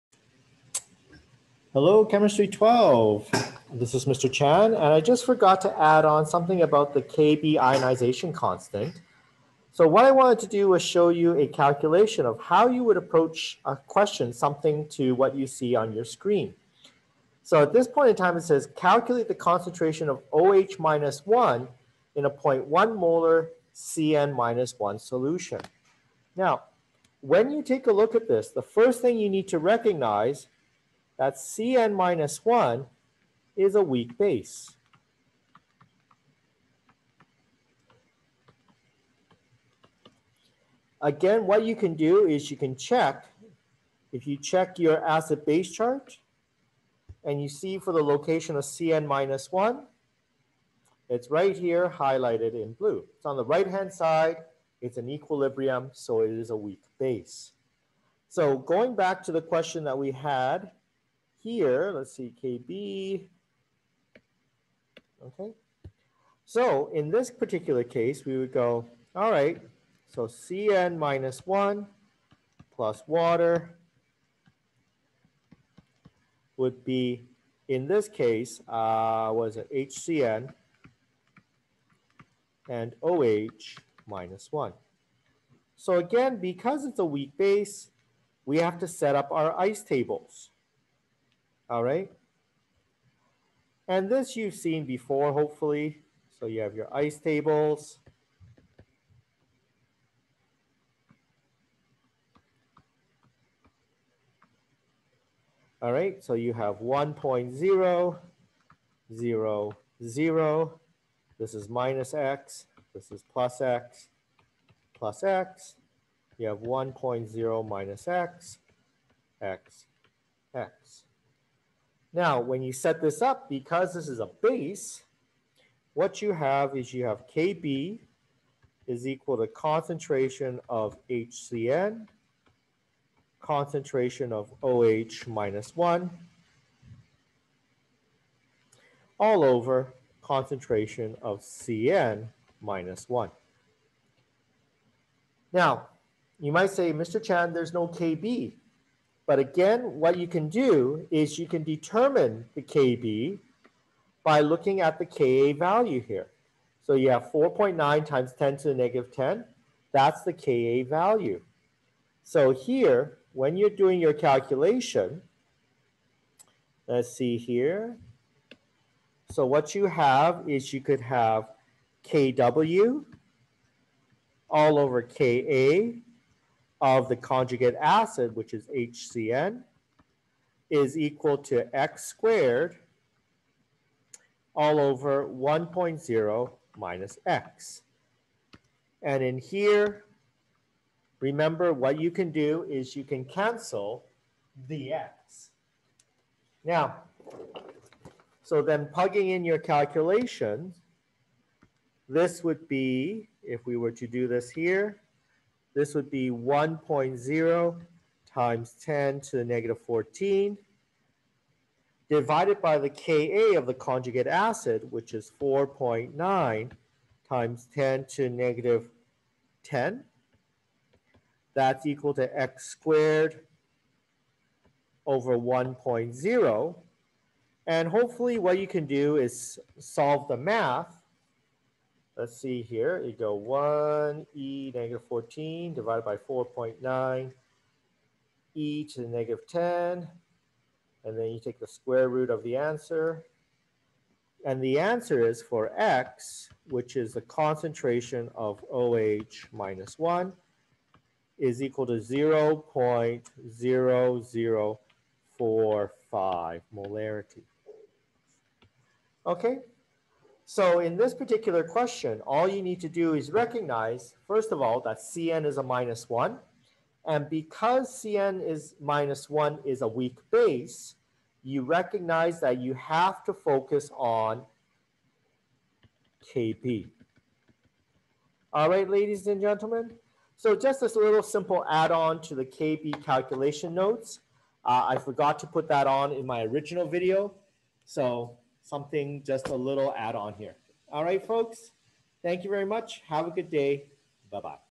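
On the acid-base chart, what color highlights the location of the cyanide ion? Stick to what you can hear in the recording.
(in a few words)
blue.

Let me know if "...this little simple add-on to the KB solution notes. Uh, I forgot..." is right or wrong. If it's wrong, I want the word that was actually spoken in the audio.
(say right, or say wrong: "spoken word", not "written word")
wrong: "calculation", not "solution".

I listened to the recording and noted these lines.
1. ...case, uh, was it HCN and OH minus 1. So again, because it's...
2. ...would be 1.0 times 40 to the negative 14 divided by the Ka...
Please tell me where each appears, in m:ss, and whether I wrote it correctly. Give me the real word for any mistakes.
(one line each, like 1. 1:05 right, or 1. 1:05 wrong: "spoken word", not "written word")
1. 1:18 right
2. 3:25 wrong: "10", not "40".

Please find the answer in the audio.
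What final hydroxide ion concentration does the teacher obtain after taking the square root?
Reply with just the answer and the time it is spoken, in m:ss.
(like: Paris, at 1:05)
0.0045 M, at 4:11.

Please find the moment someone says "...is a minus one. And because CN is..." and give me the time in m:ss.
4:25.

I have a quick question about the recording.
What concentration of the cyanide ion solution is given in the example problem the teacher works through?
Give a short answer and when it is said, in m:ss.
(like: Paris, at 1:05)
0.1 molar, at 0:22.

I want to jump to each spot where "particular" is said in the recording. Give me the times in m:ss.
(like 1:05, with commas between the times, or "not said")
1:07, 4:21.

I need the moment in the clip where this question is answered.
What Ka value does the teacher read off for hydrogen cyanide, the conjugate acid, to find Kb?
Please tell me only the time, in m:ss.
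2:37.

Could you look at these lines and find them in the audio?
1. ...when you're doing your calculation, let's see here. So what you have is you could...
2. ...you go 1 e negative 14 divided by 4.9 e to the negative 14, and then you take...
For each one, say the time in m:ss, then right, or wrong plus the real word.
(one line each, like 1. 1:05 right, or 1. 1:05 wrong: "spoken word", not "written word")
1. 2:43 right
2. 3:53 wrong: "10", not "14".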